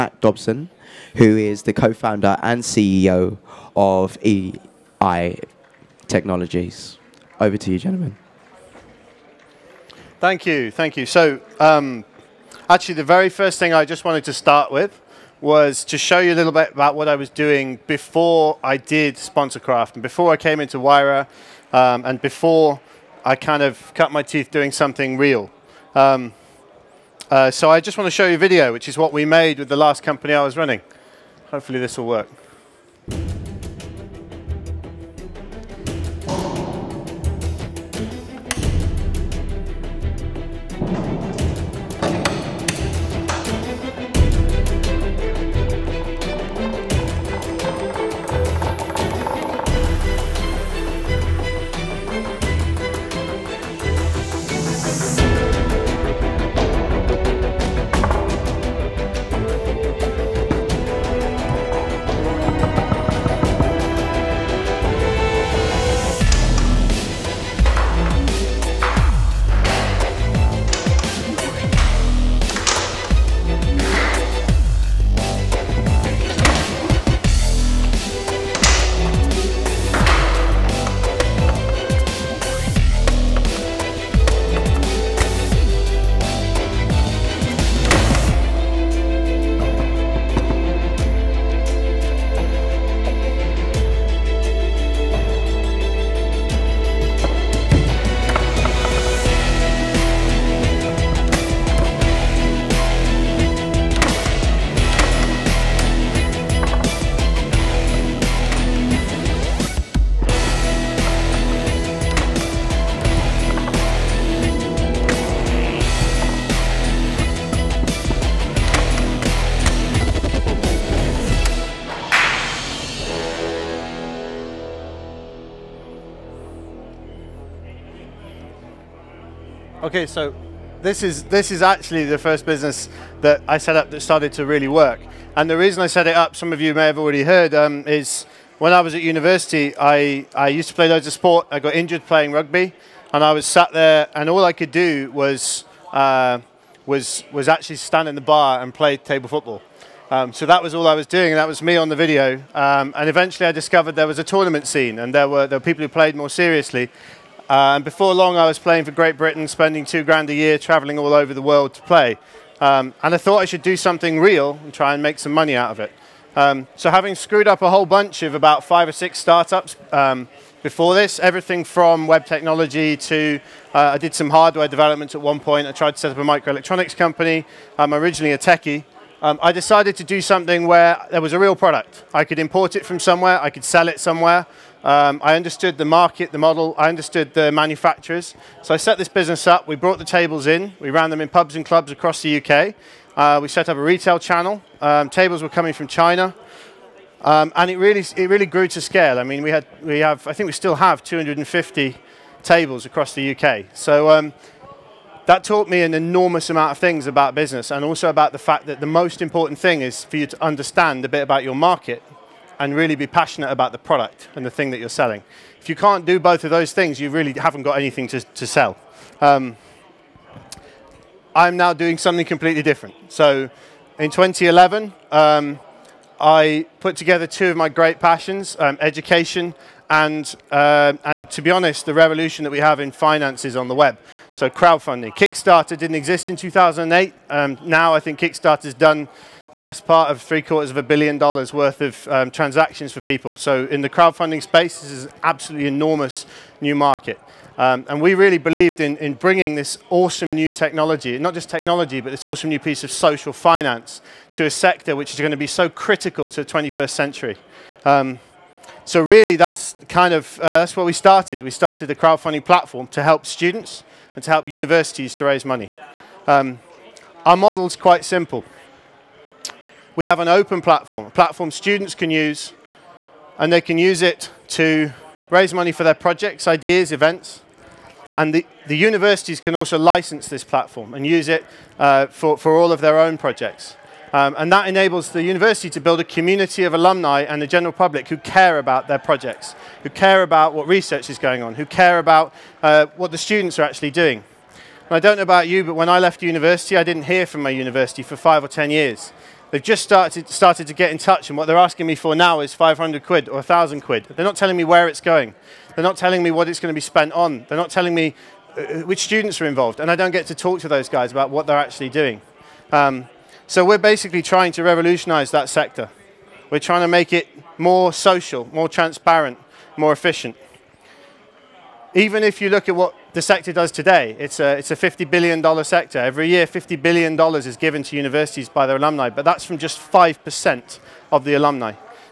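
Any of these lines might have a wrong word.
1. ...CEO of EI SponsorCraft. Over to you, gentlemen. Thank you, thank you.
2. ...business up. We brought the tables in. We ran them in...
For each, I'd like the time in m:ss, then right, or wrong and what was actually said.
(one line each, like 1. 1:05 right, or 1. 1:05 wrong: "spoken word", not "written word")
1. 0:02 wrong: "Technologies", not "SponsorCraft"
2. 3:09 right.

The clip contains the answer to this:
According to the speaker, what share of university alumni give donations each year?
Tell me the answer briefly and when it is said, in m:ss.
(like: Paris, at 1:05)
5%, at 5:29.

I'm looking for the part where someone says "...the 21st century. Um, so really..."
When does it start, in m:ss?
4:16.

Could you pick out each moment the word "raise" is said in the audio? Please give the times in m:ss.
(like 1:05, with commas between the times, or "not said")
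4:25, 4:35.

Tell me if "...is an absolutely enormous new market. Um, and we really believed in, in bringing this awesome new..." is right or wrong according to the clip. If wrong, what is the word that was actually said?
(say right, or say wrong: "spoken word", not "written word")
right.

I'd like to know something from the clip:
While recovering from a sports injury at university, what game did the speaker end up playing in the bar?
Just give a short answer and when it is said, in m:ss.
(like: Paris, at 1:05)
table football, at 2:28.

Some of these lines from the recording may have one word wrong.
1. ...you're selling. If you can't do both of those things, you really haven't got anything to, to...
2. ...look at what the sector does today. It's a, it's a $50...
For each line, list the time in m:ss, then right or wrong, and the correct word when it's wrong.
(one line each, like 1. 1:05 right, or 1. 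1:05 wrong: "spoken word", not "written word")
1. 3:34 right
2. 5:22 right.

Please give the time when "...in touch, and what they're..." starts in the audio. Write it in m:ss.
5:00.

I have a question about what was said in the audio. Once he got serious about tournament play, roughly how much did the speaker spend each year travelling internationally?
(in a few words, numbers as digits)
two grand.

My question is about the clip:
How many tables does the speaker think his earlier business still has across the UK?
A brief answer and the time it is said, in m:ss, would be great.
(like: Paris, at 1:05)
250, at 3:21.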